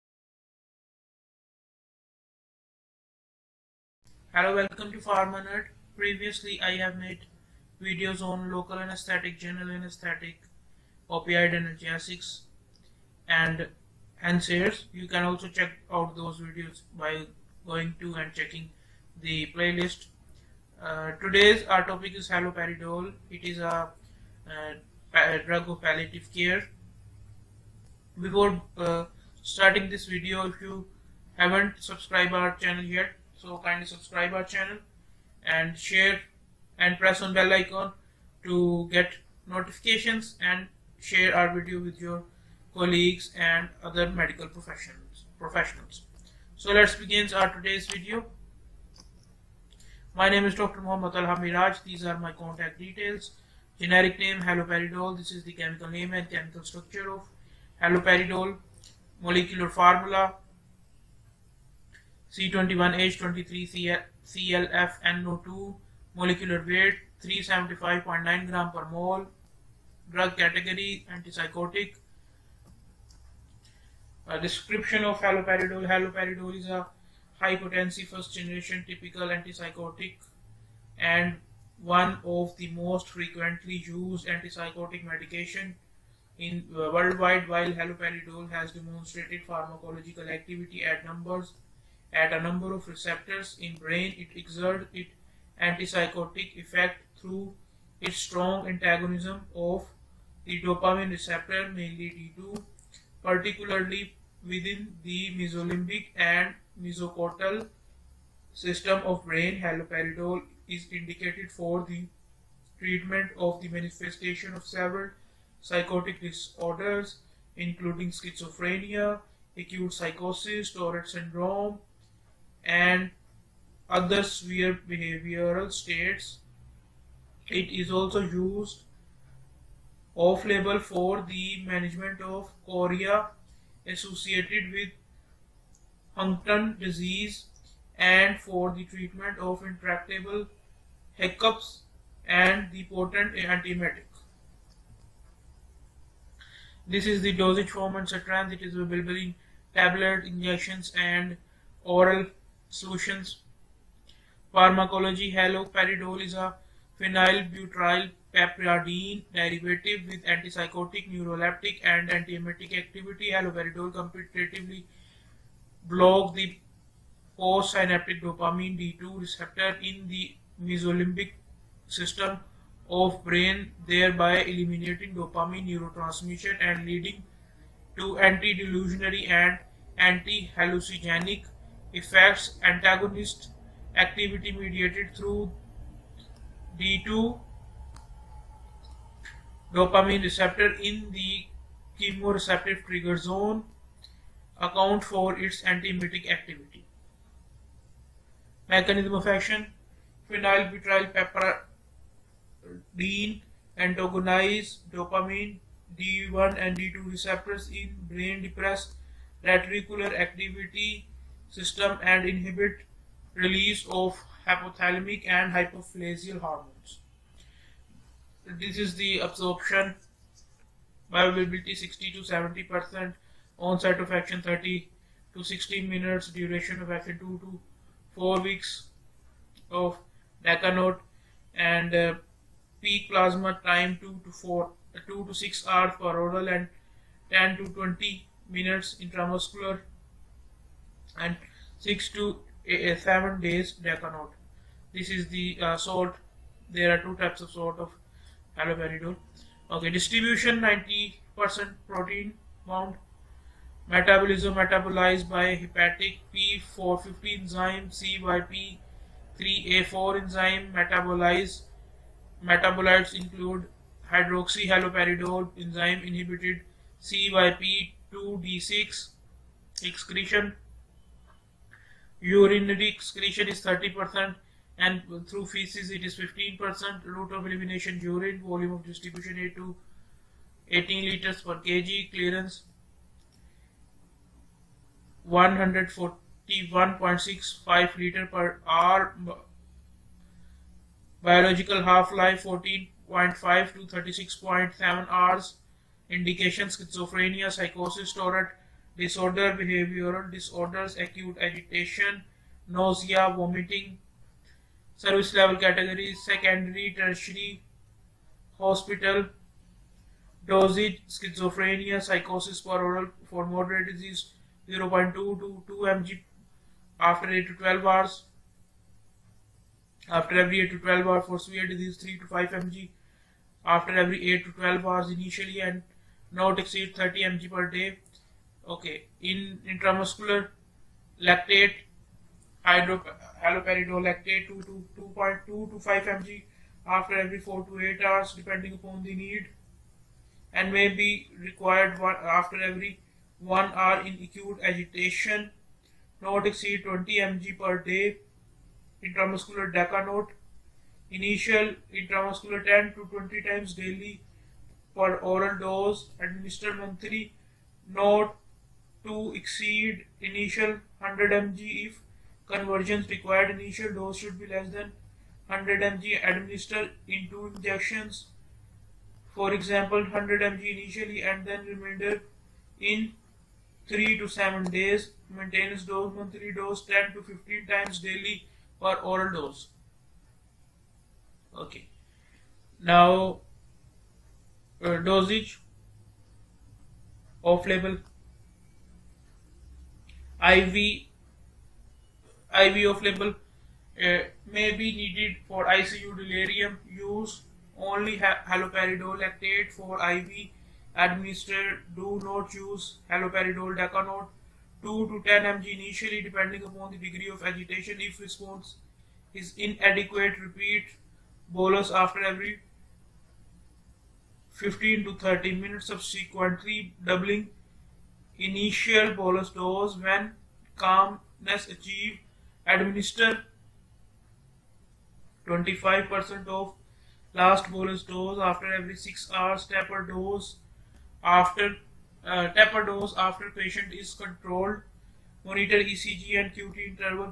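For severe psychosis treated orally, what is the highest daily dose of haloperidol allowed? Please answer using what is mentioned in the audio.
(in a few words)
30 mg.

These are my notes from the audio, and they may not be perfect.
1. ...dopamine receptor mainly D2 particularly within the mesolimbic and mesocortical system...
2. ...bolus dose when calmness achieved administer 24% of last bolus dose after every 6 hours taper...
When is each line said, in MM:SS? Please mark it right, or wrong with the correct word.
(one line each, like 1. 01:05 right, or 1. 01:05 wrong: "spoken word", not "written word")
1. 01:40 right
2. 06:59 wrong: "25", not "24".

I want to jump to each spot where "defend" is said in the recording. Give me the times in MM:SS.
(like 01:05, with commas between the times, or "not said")
not said.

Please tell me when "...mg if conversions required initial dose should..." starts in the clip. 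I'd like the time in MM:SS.
06:01.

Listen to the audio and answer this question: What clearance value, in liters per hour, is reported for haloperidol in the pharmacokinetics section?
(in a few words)
141.65.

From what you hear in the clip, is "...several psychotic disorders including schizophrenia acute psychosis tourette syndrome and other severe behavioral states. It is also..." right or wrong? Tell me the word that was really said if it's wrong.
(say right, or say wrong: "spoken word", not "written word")
wrong: "sphere", not "severe".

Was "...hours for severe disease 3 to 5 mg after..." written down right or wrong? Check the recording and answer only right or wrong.
right.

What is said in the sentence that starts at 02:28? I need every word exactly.
It is available in tablet, injections and oral Solutions Pharmacology Haloperidol is a phenylbutyryl piperidine derivative with antipsychotic, neuroleptic and antiemetic activity.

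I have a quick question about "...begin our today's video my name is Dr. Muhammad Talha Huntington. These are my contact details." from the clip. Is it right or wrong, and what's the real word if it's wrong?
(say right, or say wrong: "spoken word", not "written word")
wrong: "Meraj", not "Huntington".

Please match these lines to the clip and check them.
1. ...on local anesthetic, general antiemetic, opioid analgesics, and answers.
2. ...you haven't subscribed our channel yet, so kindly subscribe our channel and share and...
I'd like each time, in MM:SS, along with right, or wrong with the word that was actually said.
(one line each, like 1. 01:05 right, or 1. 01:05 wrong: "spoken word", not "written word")
1. 00:08 wrong: "anesthetic", not "antiemetic"
2. 00:30 right.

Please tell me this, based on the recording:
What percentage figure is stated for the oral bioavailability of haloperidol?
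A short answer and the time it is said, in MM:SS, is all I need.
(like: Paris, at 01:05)
60 to 70 percent, at 03:41.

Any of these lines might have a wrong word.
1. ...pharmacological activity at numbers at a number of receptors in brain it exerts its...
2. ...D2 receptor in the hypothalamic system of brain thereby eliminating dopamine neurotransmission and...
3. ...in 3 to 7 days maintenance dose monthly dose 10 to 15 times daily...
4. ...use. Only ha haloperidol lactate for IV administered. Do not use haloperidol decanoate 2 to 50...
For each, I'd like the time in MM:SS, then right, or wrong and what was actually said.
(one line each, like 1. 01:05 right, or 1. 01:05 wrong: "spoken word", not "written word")
1. 01:29 right
2. 02:48 wrong: "mesolimbic", not "hypothalamic"
3. 06:12 right
4. 06:36 wrong: "10", not "50".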